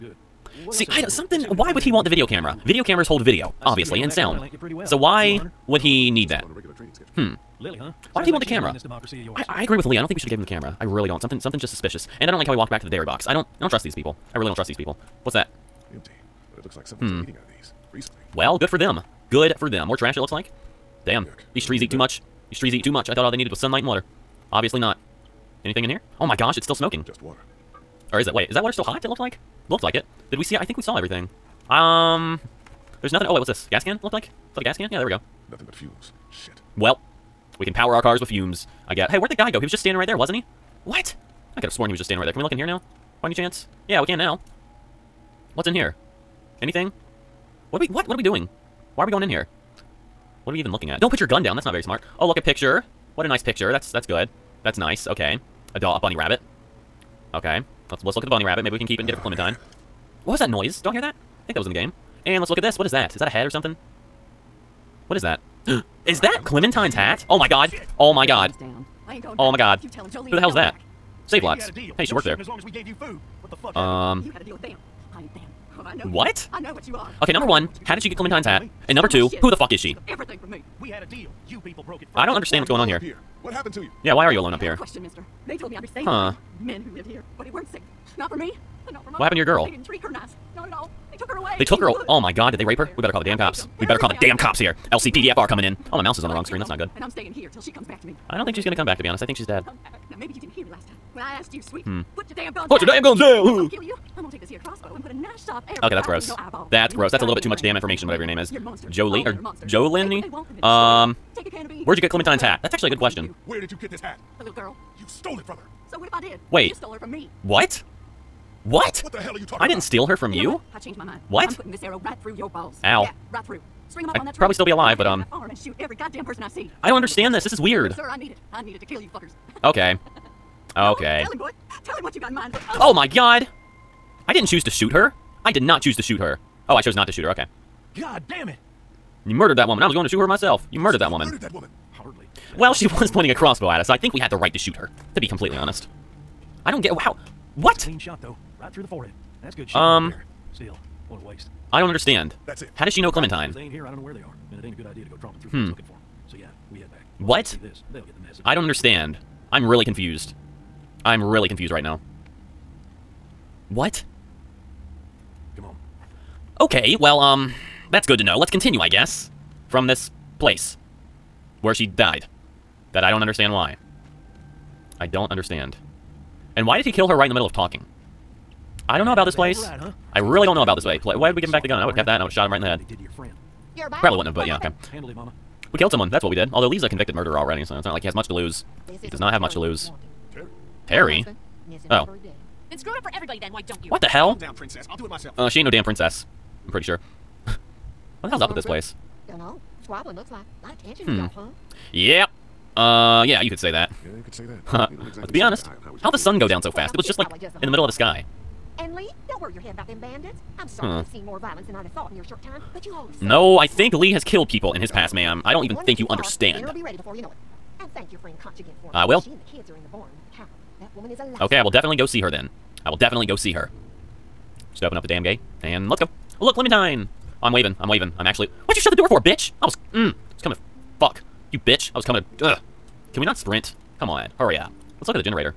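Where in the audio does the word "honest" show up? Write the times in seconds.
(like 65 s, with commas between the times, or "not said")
99 s, 145 s, 205 s.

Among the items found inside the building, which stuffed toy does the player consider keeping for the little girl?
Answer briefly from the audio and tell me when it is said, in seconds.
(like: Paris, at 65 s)
A bunny rabbit, at 55 s.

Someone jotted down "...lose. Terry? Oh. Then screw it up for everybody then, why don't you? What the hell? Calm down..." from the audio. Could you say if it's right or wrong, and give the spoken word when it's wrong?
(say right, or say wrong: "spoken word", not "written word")
right.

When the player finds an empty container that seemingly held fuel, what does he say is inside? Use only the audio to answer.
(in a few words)
Nothing but fumes.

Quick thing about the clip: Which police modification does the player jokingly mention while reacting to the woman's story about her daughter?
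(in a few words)
LCPDFR.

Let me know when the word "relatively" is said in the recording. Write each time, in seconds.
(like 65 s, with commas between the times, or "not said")
not said.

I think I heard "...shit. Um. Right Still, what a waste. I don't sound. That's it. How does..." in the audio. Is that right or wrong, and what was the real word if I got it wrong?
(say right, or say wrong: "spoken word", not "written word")
wrong: "understand", not "sound".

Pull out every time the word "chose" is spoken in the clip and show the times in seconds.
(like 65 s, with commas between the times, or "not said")
136 s.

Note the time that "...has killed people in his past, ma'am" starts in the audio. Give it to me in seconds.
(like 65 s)
214 s.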